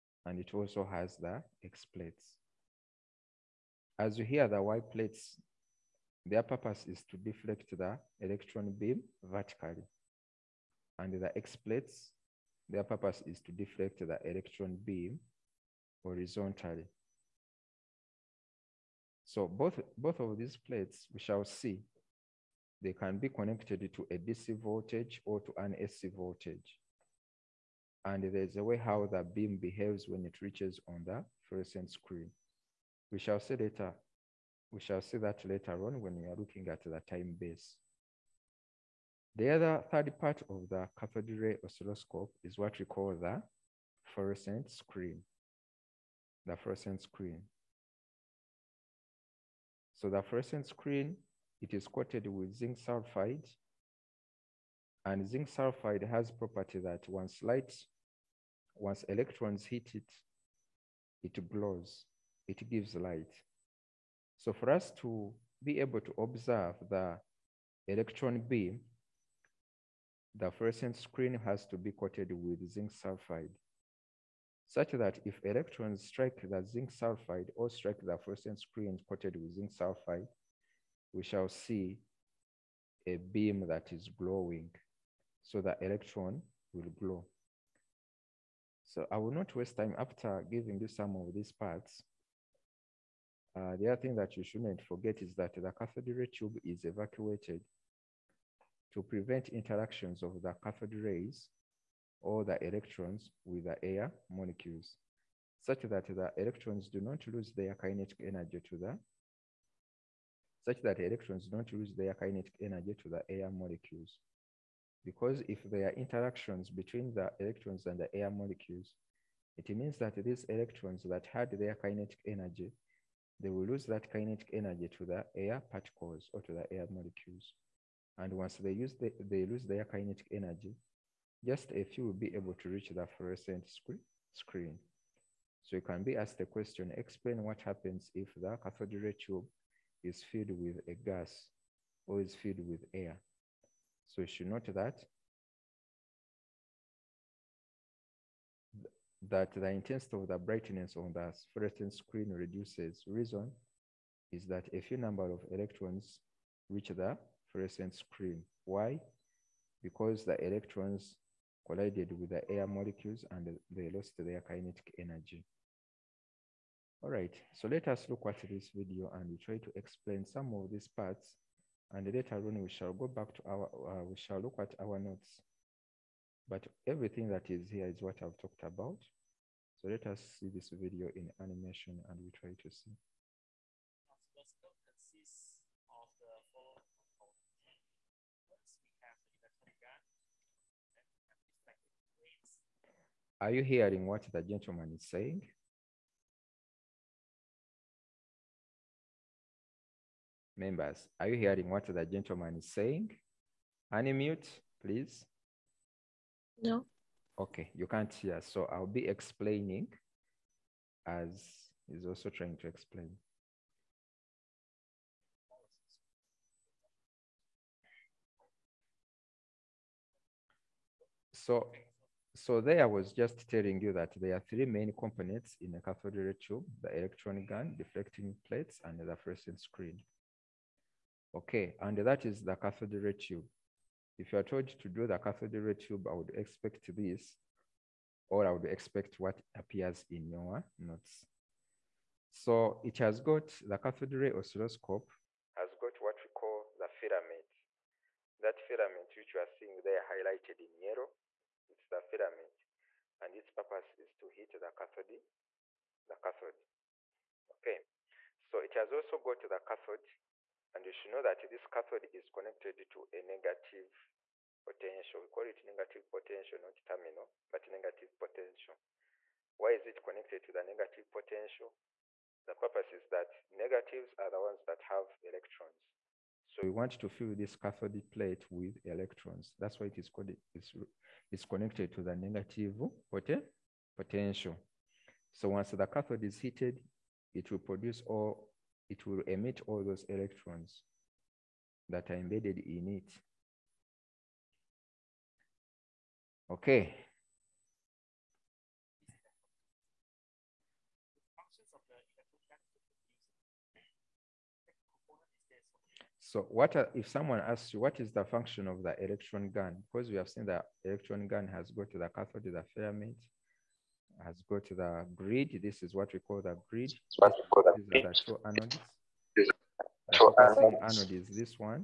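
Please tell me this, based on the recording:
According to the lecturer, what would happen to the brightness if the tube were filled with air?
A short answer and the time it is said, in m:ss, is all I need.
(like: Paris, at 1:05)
reduces, at 2:32.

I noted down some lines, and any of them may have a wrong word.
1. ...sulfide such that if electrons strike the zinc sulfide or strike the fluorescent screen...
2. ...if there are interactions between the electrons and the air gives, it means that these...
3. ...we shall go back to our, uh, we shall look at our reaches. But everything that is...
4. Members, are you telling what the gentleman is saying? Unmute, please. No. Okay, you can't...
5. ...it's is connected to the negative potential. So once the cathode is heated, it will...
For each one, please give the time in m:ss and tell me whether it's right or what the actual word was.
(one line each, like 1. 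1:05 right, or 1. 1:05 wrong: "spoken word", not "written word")
1. 1:12 right
2. 1:55 wrong: "molecules", not "gives"
3. 2:52 wrong: "notes", not "reaches"
4. 3:20 wrong: "hearing", not "telling"
5. 4:40 right.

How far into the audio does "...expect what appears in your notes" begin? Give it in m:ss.
3:58.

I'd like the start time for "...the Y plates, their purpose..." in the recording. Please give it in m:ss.
0:04.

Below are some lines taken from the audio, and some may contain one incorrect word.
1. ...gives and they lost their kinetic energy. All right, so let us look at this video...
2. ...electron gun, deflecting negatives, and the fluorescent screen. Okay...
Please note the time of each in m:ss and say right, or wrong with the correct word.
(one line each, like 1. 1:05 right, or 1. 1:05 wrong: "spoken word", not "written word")
1. 2:42 wrong: "molecules", not "gives"
2. 3:46 wrong: "plates", not "negatives".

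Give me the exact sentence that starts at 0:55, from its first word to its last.
And zinc sulfide has property that once light, once electrons hit it, it glows, it gives light.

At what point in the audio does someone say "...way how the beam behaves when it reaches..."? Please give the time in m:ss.
0:28.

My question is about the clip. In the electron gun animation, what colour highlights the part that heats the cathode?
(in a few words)
yellow.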